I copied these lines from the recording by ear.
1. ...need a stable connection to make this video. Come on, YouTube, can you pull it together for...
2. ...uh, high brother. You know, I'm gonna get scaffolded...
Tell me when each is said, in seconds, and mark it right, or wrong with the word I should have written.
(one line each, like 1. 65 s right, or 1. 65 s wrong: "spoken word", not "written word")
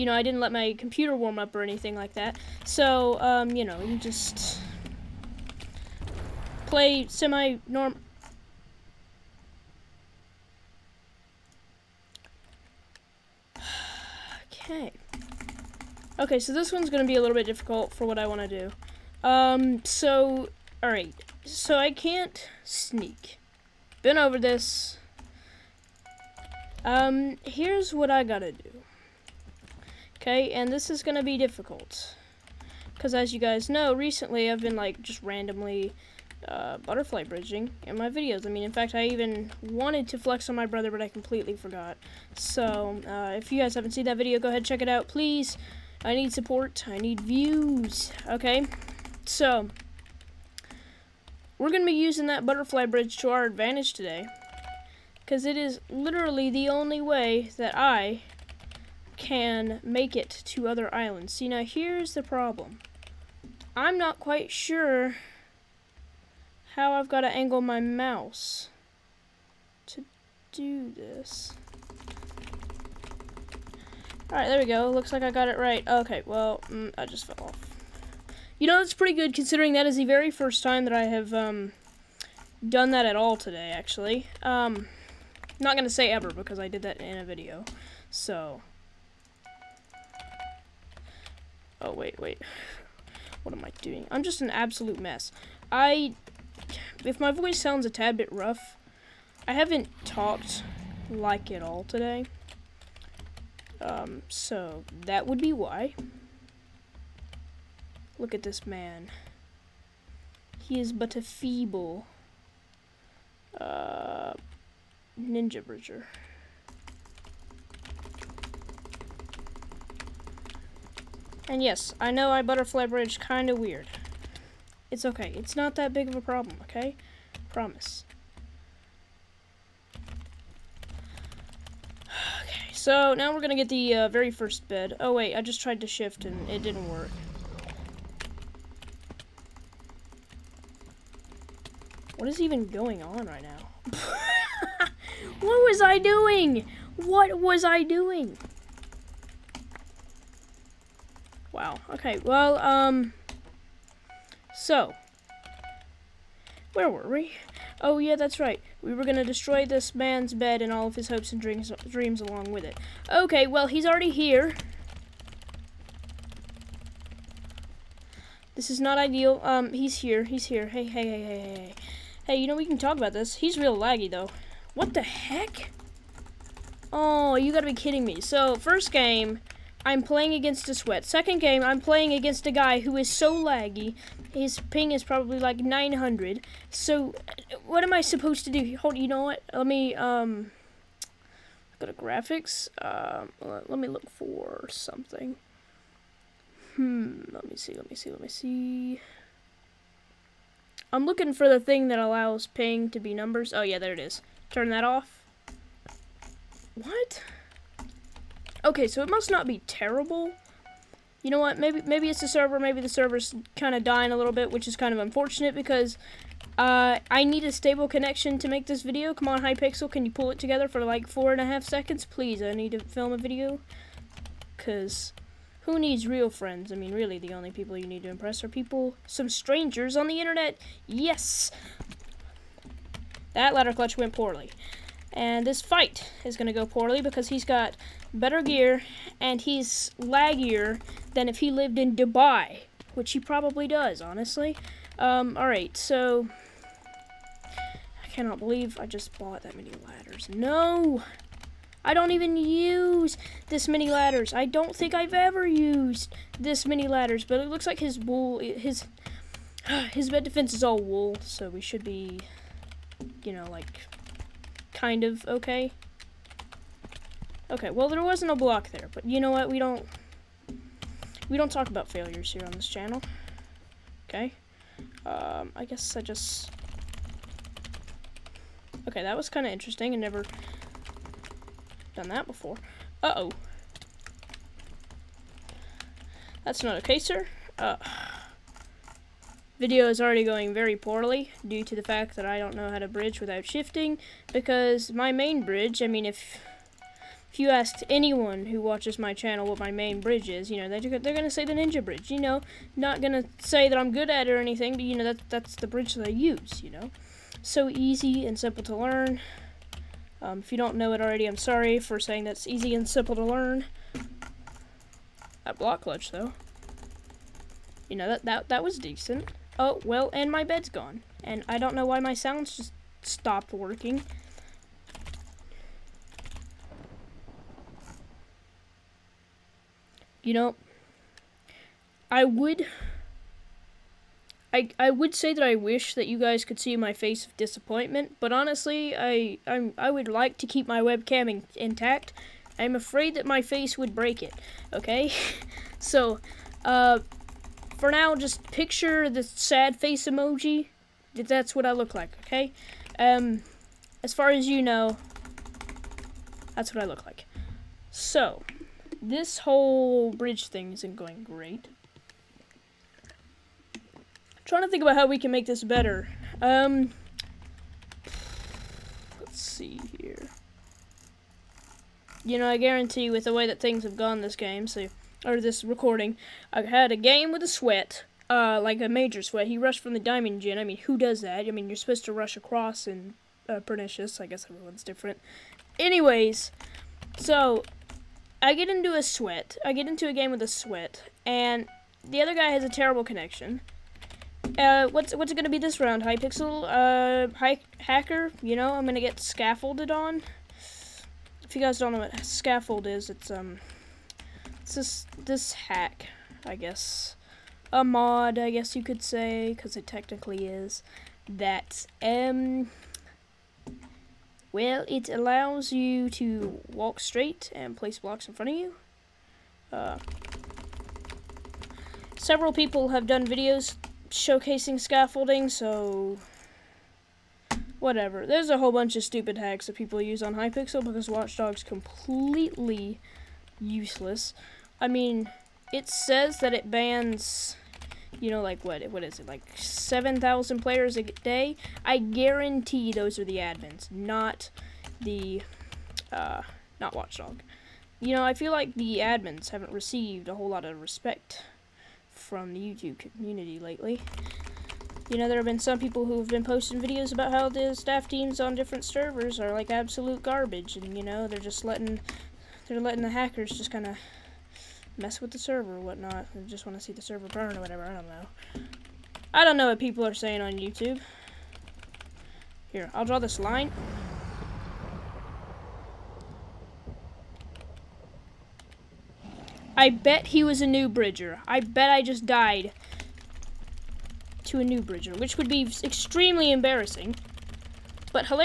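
1. 217 s wrong: "Hypixel", not "YouTube"
2. 397 s wrong: "hacker", not "brother".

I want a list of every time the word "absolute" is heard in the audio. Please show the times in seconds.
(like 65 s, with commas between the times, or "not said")
94 s, 459 s.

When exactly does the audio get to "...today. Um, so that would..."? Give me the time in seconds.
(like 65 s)
101 s.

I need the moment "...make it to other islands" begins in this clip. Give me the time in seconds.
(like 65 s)
59 s.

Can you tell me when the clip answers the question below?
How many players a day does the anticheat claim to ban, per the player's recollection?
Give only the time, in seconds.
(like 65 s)
439 s.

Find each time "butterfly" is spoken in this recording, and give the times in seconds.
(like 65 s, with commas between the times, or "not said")
36 s, 52 s, 122 s.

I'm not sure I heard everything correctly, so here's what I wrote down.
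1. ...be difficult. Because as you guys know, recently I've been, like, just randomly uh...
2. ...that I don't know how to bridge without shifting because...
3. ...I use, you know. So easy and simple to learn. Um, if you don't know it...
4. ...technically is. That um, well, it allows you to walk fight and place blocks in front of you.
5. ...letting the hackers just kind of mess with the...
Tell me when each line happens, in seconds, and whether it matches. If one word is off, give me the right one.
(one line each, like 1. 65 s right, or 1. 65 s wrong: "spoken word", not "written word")
1. 31 s right
2. 292 s right
3. 306 s right
4. 409 s wrong: "straight", not "fight"
5. 462 s right.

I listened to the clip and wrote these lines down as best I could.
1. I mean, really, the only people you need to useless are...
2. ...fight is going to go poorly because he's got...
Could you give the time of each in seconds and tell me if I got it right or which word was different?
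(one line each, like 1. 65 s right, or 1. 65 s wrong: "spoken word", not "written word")
1. 226 s wrong: "impress", not "useless"
2. 235 s right.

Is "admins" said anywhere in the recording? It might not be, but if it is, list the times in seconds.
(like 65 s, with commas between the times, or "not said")
443 s, 448 s.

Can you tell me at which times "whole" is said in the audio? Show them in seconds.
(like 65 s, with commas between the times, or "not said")
359 s, 428 s, 450 s.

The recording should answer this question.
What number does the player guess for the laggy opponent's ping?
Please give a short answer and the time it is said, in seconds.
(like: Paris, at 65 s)
900, at 185 s.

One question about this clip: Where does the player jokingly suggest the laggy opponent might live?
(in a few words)
Dubai.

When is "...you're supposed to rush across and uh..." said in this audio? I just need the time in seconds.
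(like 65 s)
381 s.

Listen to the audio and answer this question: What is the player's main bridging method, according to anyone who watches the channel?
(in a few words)
ninja bridge.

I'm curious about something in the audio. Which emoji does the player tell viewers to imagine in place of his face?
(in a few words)
sad face emoji.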